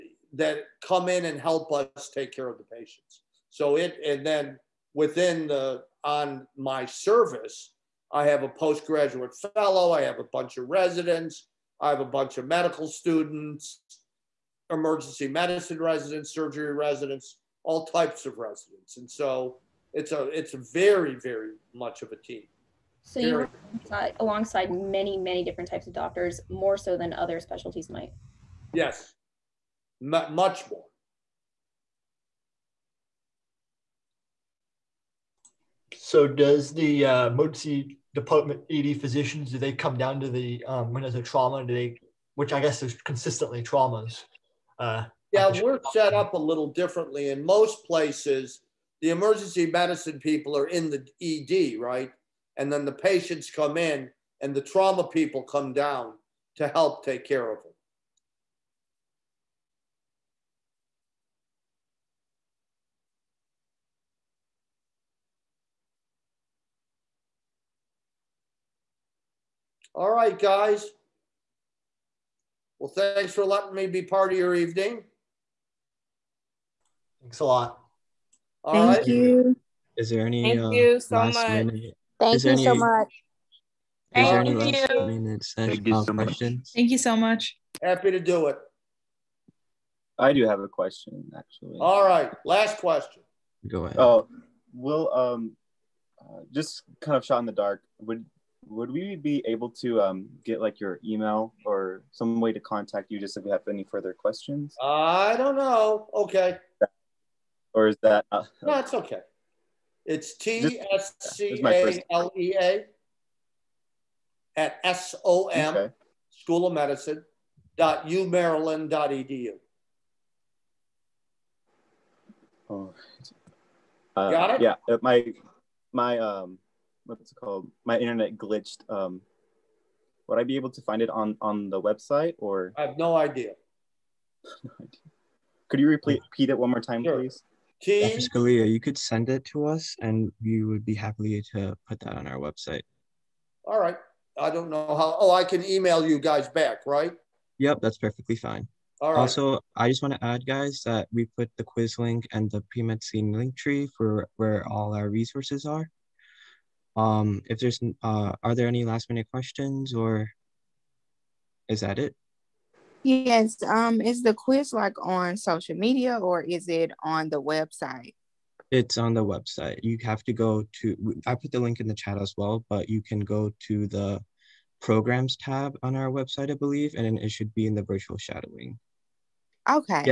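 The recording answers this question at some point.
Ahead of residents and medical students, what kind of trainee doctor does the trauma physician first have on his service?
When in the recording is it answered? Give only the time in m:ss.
0:08.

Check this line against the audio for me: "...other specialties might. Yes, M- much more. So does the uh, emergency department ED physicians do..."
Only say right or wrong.
right.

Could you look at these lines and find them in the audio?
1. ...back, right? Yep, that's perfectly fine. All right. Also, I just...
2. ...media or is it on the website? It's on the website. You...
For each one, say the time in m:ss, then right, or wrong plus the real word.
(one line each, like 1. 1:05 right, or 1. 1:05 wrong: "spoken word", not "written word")
1. 2:26 right
2. 2:45 right.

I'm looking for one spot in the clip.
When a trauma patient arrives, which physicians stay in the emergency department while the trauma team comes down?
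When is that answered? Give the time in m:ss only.
0:49.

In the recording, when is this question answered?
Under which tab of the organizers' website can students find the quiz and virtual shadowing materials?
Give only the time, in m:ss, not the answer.
2:54.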